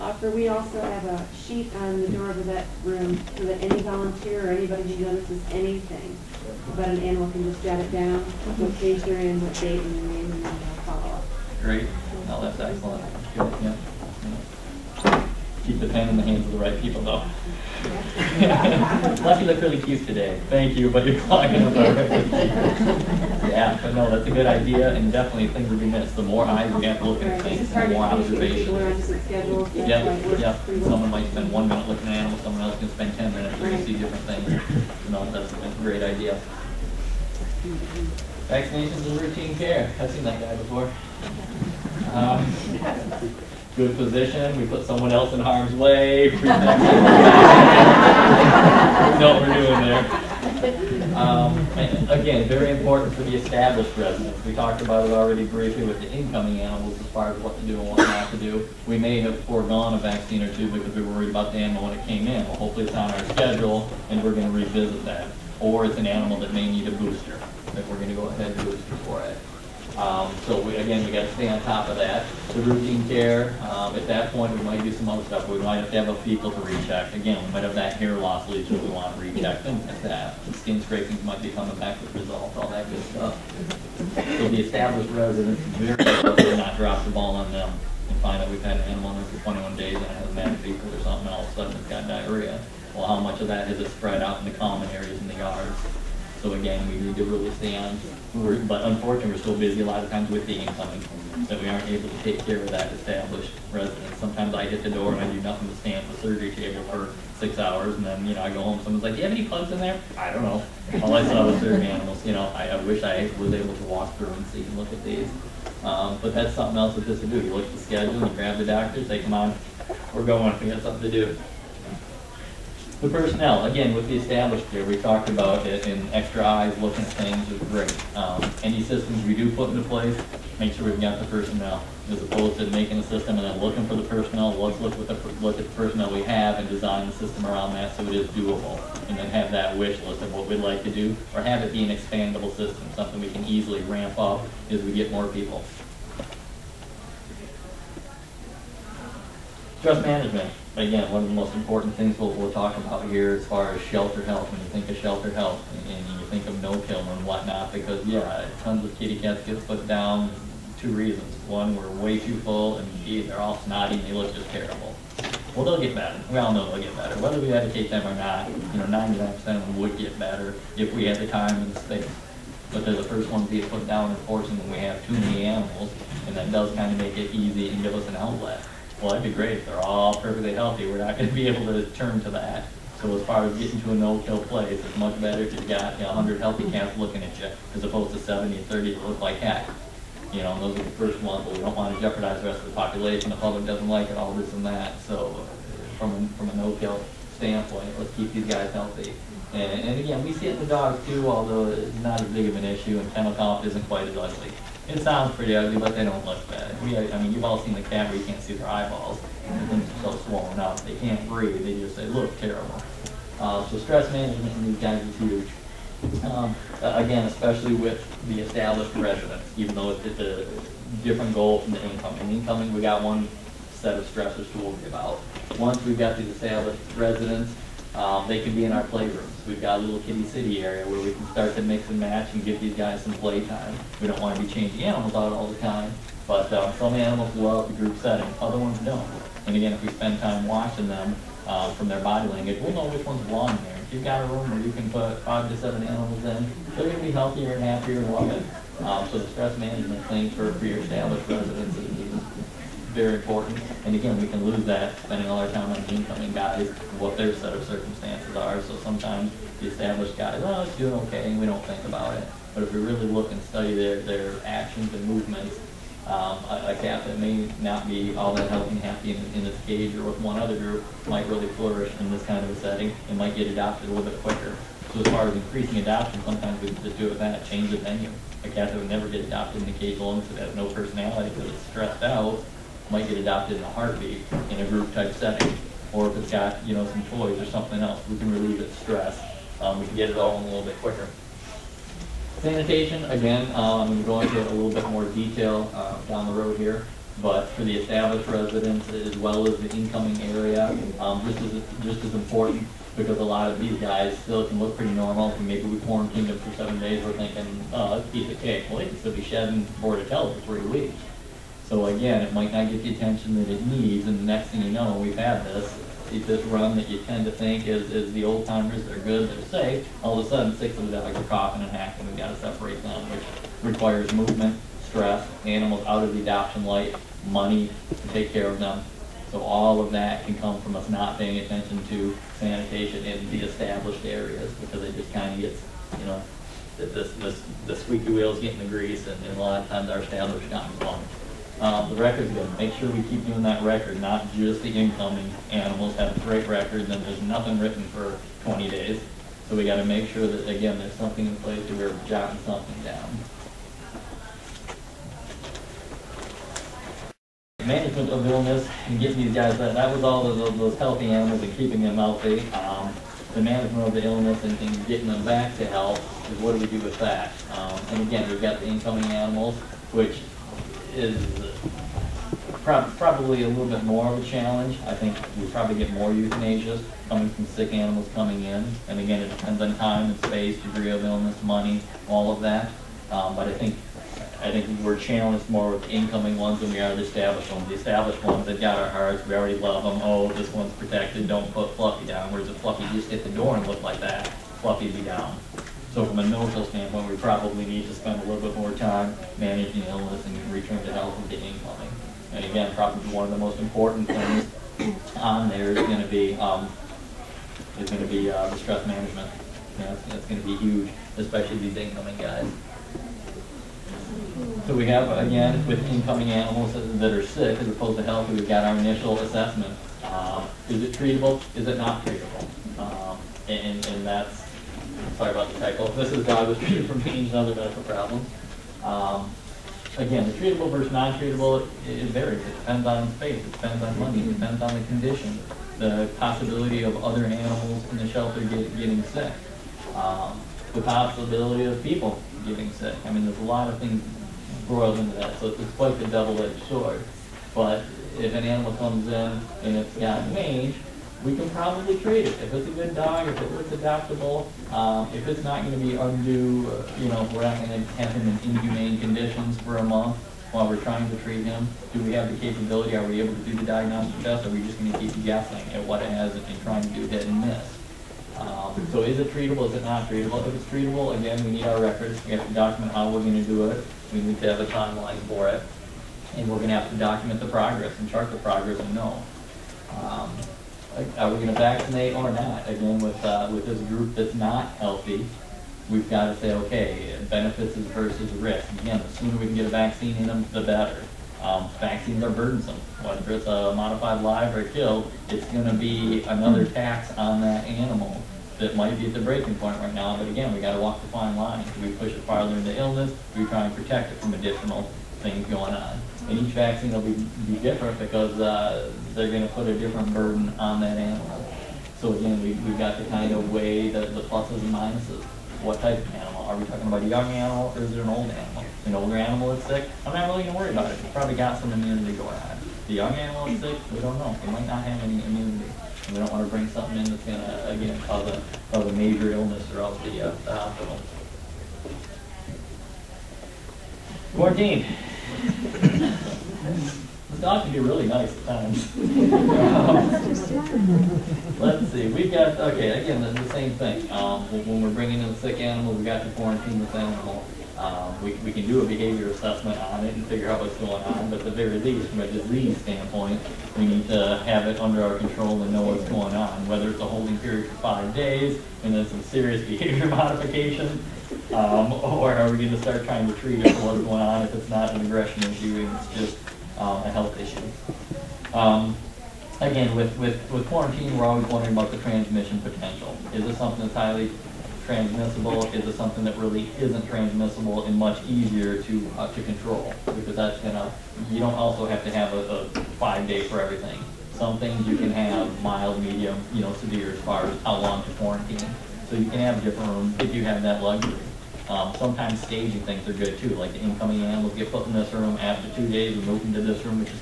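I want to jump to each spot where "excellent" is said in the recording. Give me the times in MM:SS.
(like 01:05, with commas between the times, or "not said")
00:12.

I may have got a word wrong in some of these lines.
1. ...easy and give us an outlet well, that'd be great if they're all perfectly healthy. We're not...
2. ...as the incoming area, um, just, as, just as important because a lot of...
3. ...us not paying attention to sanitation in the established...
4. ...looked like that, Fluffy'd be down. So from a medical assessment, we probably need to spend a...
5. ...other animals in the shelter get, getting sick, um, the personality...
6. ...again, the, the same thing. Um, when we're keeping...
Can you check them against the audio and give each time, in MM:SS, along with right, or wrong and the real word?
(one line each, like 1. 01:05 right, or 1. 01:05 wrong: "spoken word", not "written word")
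1. 02:57 right
2. 04:59 right
3. 05:30 right
4. 06:33 wrong: "standpoint", not "assessment"
5. 07:17 wrong: "possibility", not "personality"
6. 09:03 wrong: "bringing", not "keeping".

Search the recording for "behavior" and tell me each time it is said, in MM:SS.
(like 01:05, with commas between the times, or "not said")
09:08, 09:19.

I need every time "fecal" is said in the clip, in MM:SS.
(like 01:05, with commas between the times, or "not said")
01:16, 01:30.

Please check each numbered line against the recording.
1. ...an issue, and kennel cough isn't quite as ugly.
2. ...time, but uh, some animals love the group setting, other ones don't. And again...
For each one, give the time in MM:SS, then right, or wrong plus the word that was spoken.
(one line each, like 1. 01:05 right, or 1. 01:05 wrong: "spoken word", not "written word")
1. 03:22 right
2. 03:55 right.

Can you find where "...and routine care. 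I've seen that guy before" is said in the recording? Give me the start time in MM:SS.
00:39.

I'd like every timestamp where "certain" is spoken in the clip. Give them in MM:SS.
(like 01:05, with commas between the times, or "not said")
01:51.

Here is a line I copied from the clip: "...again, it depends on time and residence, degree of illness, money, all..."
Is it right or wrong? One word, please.
wrong.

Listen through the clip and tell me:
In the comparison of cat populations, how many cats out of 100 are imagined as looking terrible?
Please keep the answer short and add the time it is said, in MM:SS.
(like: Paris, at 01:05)
30, at 03:08.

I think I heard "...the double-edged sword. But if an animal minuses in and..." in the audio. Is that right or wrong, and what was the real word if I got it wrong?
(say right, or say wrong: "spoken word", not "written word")
wrong: "comes", not "minuses".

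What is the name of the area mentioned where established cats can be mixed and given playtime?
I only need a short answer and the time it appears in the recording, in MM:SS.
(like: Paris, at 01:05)
Kitty city, at 03:49.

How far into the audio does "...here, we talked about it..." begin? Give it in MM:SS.
02:04.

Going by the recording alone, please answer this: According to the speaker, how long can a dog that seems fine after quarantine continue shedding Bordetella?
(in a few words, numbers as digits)
3 weeks.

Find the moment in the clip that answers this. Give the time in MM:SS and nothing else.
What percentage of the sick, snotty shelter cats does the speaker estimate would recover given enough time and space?
02:49.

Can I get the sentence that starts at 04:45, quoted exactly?
Or if it's got, you know, some toys or something else, we can relieve its stress.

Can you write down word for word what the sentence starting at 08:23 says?
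Do we try and protect it from additional things going on?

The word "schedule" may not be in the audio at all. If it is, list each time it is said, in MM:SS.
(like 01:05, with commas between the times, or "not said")
01:03, 01:57.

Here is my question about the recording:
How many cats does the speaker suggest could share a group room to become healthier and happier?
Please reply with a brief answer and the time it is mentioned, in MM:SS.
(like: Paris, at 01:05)
5 to 7, at 04:05.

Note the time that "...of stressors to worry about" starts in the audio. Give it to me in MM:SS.
03:43.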